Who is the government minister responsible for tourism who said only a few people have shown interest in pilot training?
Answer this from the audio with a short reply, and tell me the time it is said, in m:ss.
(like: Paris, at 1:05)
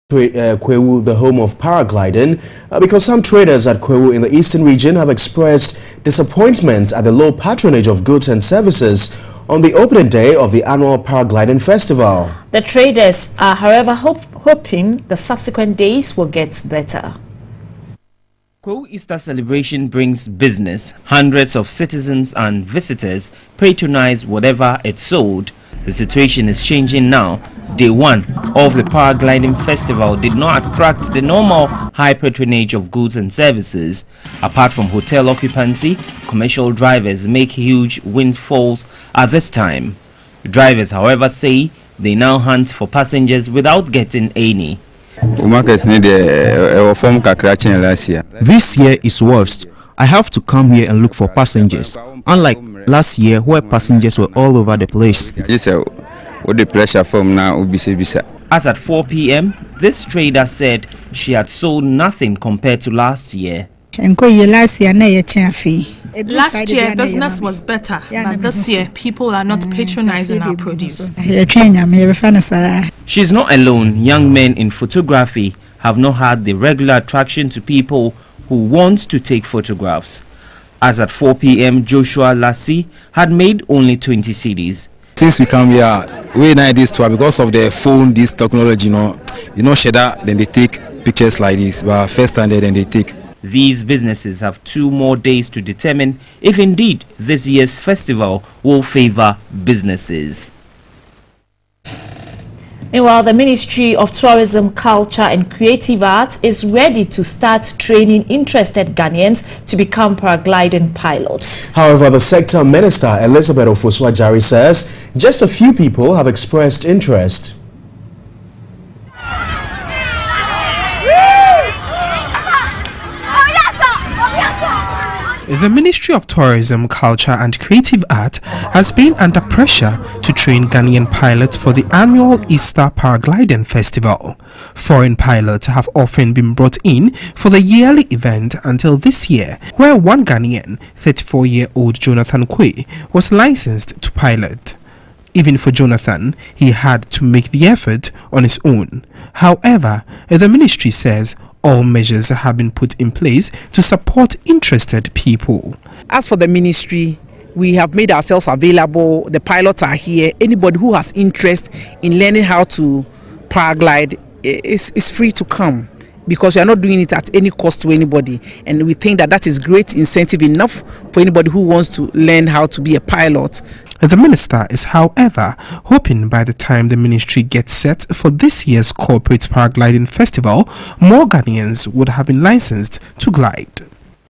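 Elizabeth Jari, at 1:53.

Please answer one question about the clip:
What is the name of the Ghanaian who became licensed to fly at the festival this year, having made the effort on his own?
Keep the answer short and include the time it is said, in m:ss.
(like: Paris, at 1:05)
Jonathan Kwe, at 2:21.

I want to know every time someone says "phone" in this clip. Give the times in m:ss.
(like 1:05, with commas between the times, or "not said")
1:27.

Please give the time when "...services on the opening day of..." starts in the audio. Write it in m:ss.
0:08.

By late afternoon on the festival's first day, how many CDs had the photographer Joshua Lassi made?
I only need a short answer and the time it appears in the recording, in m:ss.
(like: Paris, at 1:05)
20, at 1:23.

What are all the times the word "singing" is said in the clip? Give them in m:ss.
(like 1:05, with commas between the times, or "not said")
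not said.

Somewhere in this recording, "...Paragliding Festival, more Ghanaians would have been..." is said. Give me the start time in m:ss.
2:59.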